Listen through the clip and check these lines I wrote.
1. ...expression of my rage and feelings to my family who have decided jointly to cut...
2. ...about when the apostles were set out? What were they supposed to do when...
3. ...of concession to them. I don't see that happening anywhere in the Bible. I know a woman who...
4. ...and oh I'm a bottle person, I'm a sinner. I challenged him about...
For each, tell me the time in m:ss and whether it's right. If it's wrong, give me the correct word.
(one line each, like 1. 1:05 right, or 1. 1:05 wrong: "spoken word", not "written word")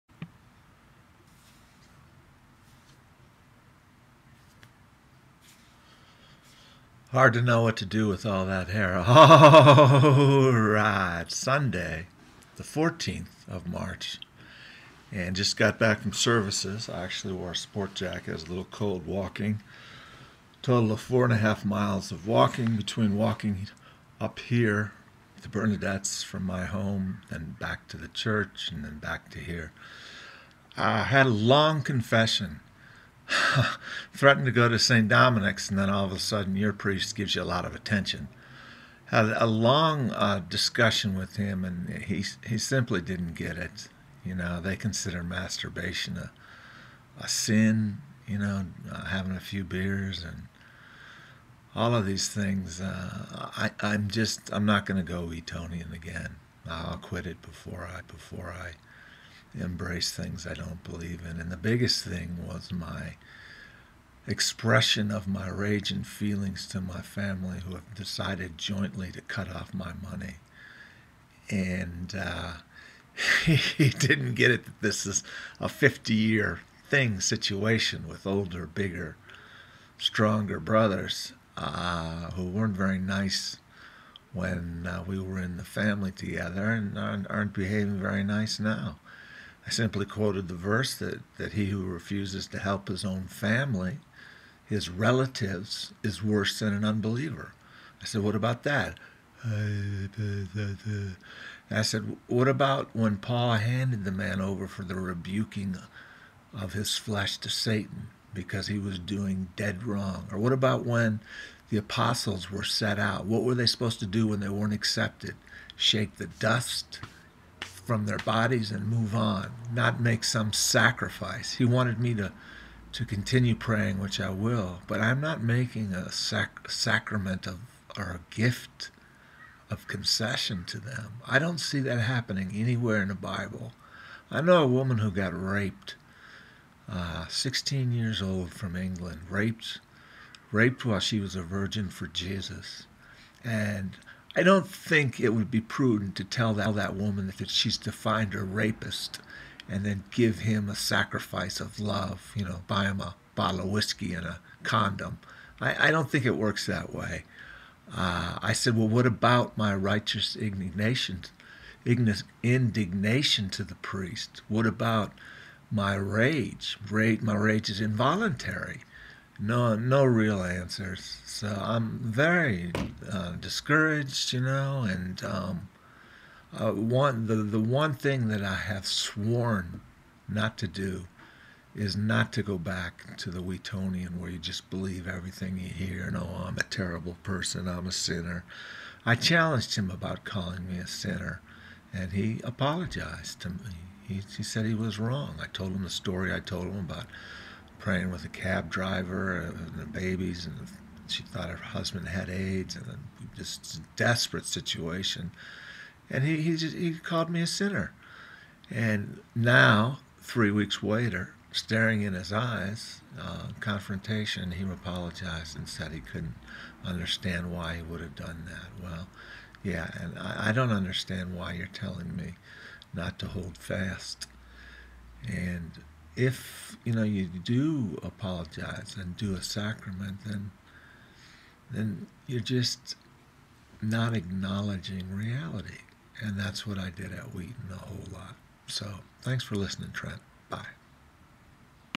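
1. 1:04 right
2. 1:50 right
3. 2:09 right
4. 3:06 wrong: "terrible", not "bottle".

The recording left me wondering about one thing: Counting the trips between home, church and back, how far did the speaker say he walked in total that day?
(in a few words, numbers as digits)
4.5 miles.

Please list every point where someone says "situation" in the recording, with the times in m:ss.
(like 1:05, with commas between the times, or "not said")
1:17, 3:24.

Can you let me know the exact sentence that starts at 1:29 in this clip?
I simply quoted the verse that, that he who refuses to help his own family, his relatives, is worse than an unbeliever.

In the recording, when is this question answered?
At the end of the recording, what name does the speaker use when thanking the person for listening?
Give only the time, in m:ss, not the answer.
3:59.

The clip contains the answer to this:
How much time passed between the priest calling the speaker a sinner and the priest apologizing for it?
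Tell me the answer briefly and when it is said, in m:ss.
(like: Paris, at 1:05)
3 weeks, at 3:30.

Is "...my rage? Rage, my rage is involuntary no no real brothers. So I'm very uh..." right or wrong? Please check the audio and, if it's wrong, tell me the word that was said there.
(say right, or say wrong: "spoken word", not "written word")
wrong: "answers", not "brothers".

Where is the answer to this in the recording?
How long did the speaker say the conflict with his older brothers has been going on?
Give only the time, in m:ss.
1:15.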